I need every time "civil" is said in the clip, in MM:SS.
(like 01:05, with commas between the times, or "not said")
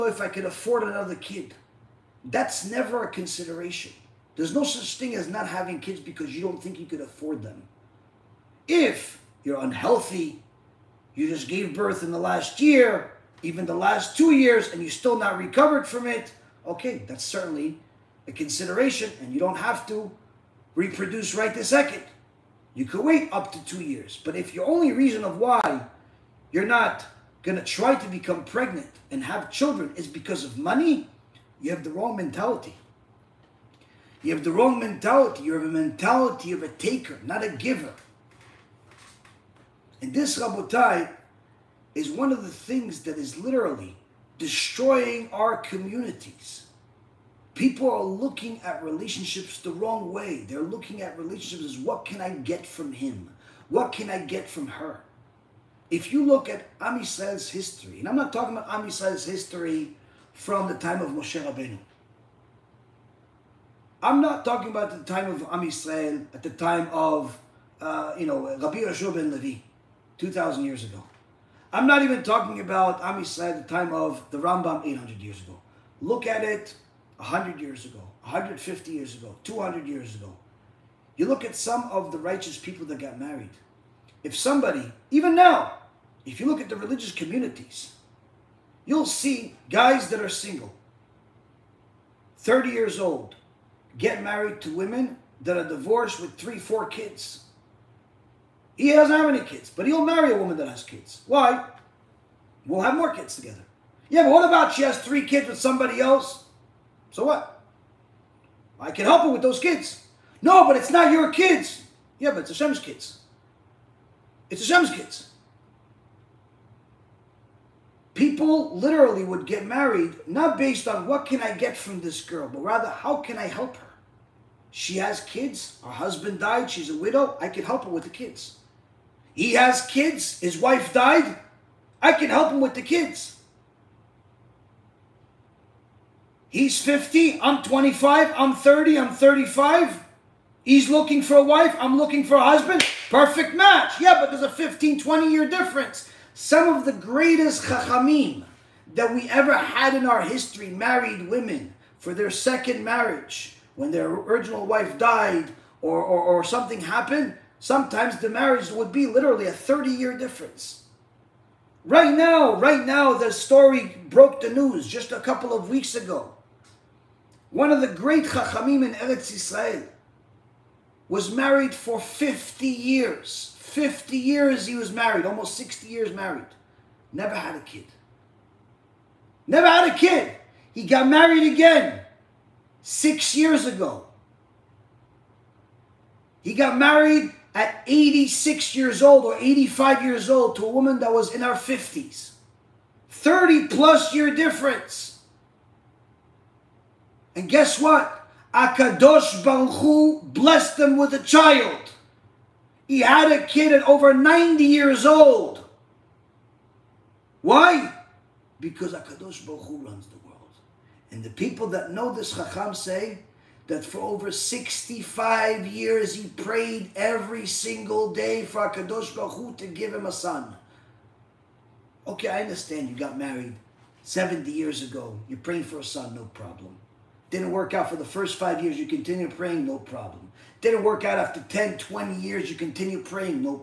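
not said.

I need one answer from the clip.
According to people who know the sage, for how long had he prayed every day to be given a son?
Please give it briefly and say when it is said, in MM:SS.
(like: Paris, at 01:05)
over 65 years, at 03:33.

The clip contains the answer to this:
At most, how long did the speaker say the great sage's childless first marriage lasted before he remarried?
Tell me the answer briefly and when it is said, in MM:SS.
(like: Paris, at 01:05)
almost 60 years, at 02:55.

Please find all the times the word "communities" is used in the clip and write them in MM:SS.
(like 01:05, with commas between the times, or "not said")
00:45, 01:27.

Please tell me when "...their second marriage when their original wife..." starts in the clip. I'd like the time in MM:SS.
02:32.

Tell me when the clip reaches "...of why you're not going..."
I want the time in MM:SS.
00:25.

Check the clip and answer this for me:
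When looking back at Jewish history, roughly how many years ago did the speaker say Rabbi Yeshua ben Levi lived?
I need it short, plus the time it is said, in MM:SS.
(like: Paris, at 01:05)
2,000 years, at 01:10.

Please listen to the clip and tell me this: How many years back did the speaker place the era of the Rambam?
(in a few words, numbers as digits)
800 years.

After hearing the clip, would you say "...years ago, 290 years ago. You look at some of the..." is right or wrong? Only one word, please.
wrong.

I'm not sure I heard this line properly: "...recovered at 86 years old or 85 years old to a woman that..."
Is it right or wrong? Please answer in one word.
wrong.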